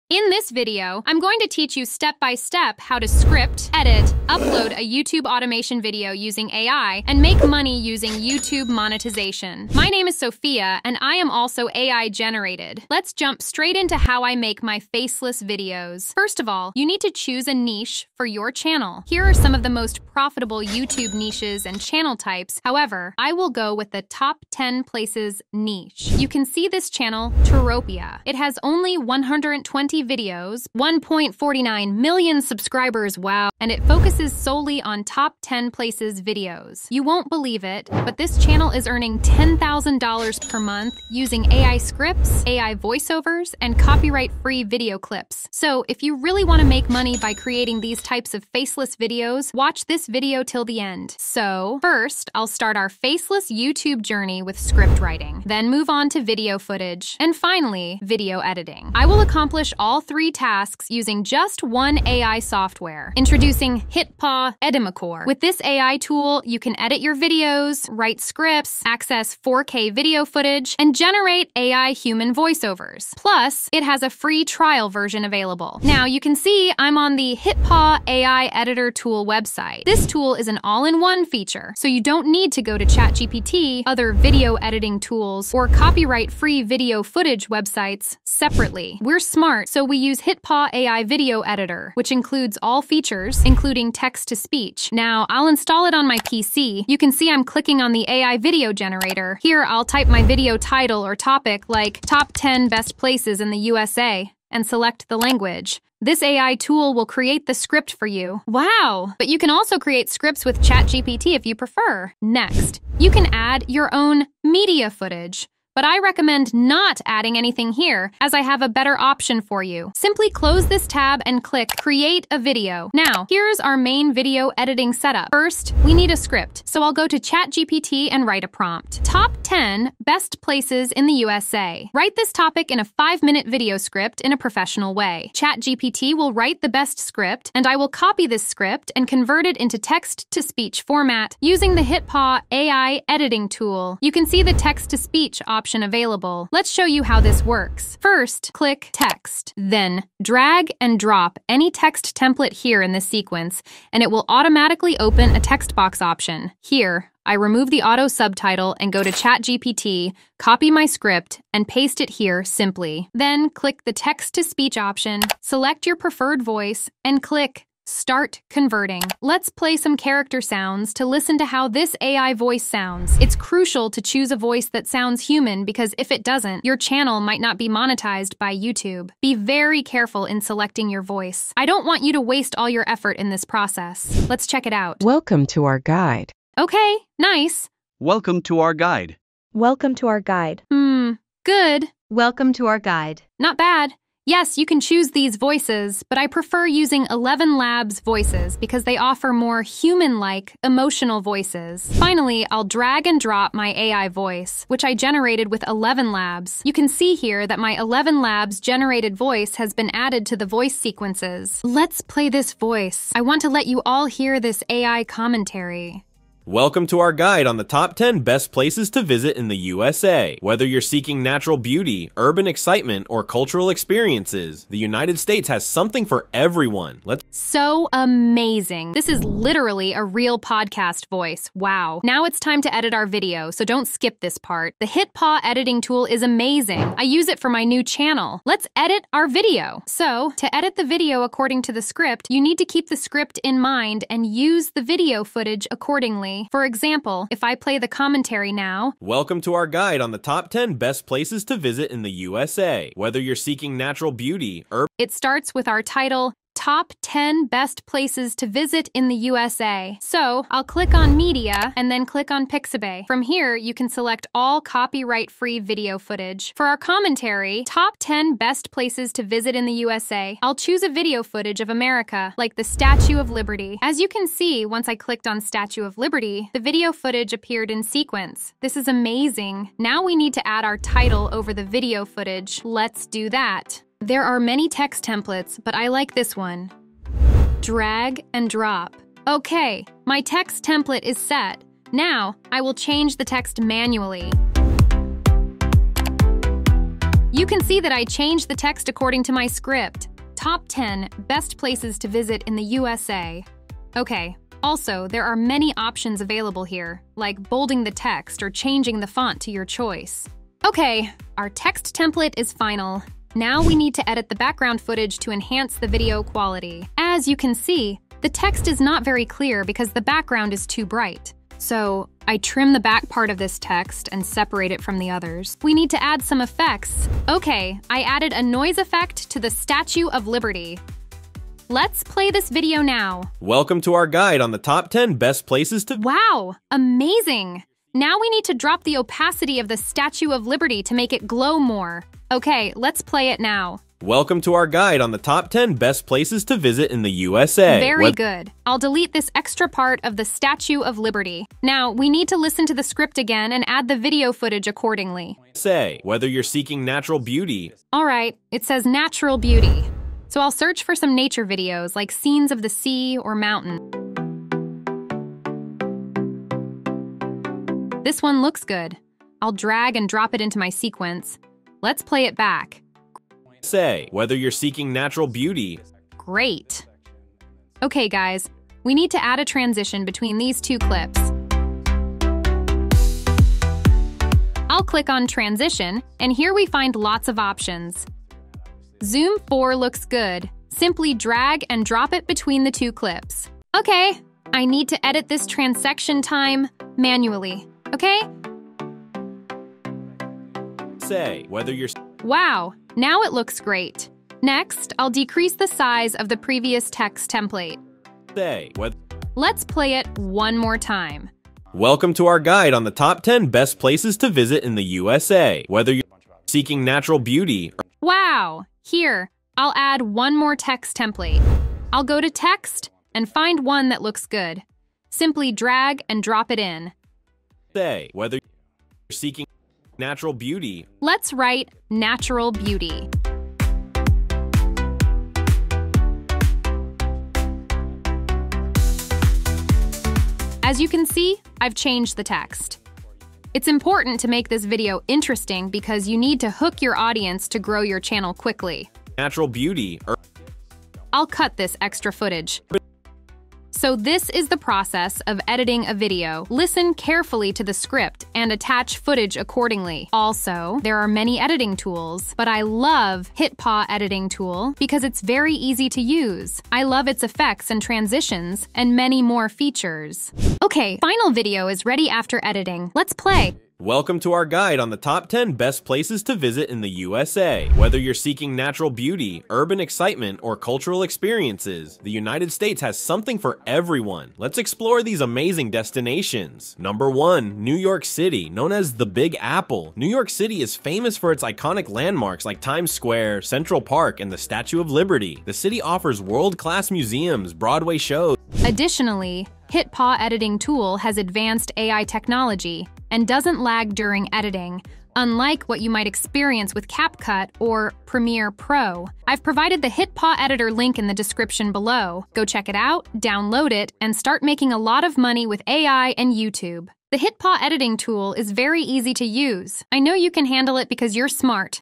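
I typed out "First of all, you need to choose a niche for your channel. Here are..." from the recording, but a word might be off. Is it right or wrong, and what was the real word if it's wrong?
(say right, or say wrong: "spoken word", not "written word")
right.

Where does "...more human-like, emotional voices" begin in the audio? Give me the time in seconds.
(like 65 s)
199 s.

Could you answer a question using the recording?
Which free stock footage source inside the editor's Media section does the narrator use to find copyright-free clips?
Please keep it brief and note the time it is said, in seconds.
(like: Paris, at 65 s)
Pixabay, at 262 s.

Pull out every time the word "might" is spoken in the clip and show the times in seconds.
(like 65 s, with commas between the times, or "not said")
177 s, 505 s.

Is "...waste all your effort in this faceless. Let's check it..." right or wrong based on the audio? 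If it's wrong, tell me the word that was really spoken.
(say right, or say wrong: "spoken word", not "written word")
wrong: "process", not "faceless".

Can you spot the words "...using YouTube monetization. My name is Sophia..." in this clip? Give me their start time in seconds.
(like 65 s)
7 s.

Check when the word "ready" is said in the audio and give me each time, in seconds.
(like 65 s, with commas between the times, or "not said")
471 s.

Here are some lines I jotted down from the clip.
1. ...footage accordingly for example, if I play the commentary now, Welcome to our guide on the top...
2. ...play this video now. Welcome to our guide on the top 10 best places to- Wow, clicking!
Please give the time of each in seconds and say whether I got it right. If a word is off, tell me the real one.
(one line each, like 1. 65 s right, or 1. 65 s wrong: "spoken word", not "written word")
1. 245 s right
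2. 332 s wrong: "amazing", not "clicking".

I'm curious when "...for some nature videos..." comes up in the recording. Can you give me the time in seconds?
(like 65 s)
360 s.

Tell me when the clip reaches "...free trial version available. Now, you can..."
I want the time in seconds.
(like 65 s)
74 s.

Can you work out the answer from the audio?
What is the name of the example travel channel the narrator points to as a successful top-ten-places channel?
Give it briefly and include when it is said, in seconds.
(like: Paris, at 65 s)
Touropia, at 27 s.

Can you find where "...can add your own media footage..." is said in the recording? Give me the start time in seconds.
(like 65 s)
113 s.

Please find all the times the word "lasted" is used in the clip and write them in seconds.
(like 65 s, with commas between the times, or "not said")
not said.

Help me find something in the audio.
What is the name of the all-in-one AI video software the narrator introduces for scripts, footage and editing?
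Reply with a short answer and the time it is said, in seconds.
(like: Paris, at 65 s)
HitPaw Edimakor, at 63 s.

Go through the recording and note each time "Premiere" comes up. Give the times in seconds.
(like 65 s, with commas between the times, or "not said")
508 s.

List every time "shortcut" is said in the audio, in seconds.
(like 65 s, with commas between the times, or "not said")
not said.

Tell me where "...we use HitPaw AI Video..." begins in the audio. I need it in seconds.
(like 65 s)
89 s.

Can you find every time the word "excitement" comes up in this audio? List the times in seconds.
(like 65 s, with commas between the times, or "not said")
222 s, 479 s.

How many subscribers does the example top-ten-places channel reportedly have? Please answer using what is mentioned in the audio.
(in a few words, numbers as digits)
1.49 million.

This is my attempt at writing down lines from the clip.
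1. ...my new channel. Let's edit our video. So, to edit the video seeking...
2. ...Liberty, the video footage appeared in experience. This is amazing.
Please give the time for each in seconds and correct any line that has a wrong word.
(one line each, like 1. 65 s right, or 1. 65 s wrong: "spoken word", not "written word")
1. 237 s wrong: "according", not "seeking"
2. 275 s wrong: "sequence", not "experience".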